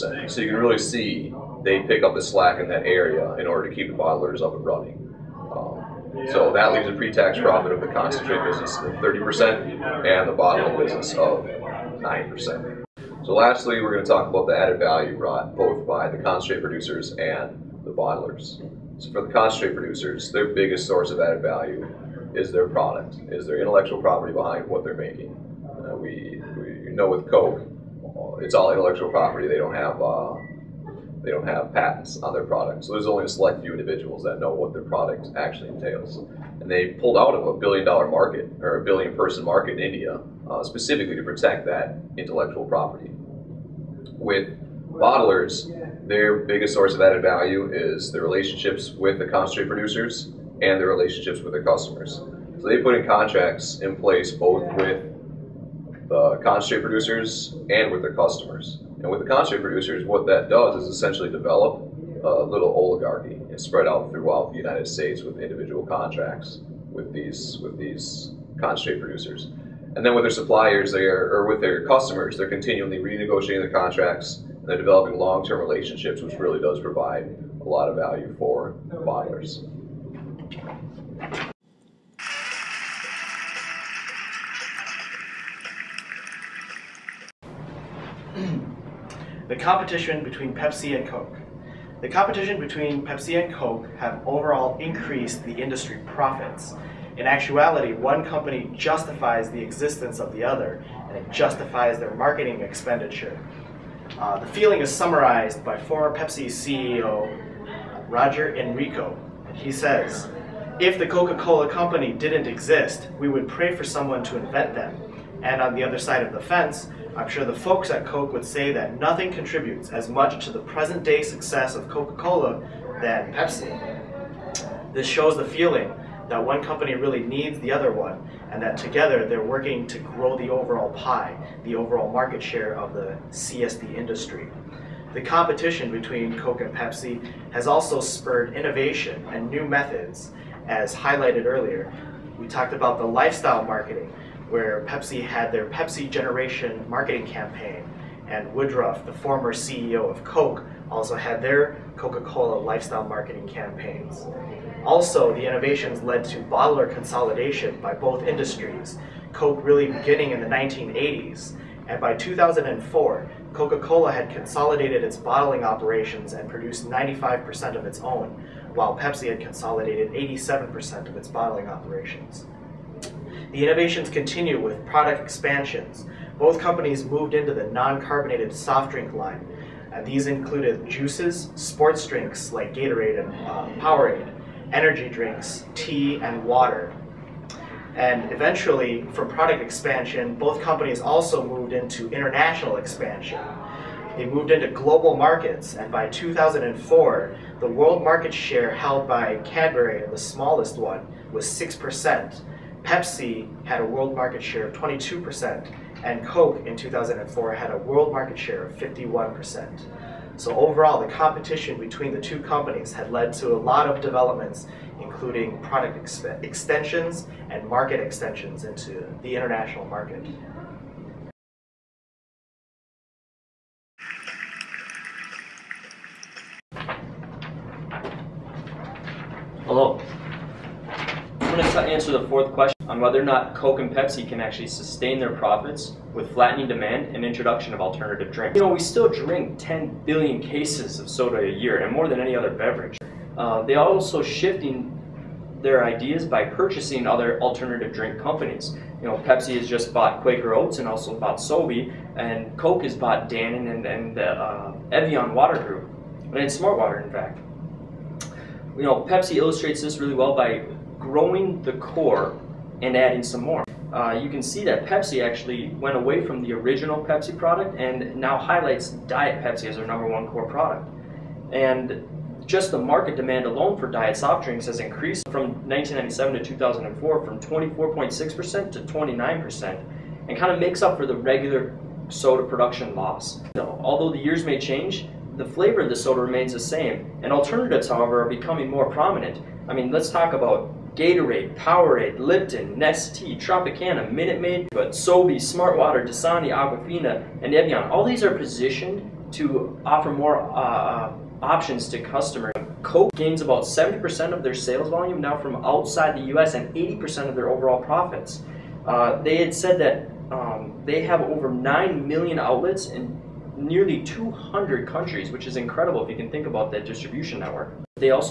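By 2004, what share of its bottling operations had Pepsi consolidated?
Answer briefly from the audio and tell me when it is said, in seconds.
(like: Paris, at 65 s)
87%, at 170 s.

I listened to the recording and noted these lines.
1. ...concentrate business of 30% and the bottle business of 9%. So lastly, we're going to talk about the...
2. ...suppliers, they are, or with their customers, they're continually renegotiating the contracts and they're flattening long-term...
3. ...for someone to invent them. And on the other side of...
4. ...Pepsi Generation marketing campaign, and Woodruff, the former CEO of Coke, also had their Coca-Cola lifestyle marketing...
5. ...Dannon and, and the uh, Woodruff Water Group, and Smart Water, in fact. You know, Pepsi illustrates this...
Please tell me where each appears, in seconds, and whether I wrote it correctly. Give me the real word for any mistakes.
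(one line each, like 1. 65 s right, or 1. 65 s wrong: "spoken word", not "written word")
1. 7 s right
2. 70 s wrong: "developing", not "flattening"
3. 113 s right
4. 145 s right
5. 253 s wrong: "Evian", not "Woodruff".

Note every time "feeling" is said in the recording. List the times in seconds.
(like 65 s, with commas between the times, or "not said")
104 s, 125 s.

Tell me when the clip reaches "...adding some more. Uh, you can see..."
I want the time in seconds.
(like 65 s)
262 s.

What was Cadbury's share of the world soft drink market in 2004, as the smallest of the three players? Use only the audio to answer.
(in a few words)
6%.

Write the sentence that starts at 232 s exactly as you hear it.
question on whether or not Coke and Pepsi can actually sustain their profits with flattening demand and introduction of alternative drinks.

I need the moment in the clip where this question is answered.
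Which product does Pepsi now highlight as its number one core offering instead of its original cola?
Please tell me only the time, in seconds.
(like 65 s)
269 s.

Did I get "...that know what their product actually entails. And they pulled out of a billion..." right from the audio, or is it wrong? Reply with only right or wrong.
right.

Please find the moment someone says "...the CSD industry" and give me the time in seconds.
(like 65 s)
132 s.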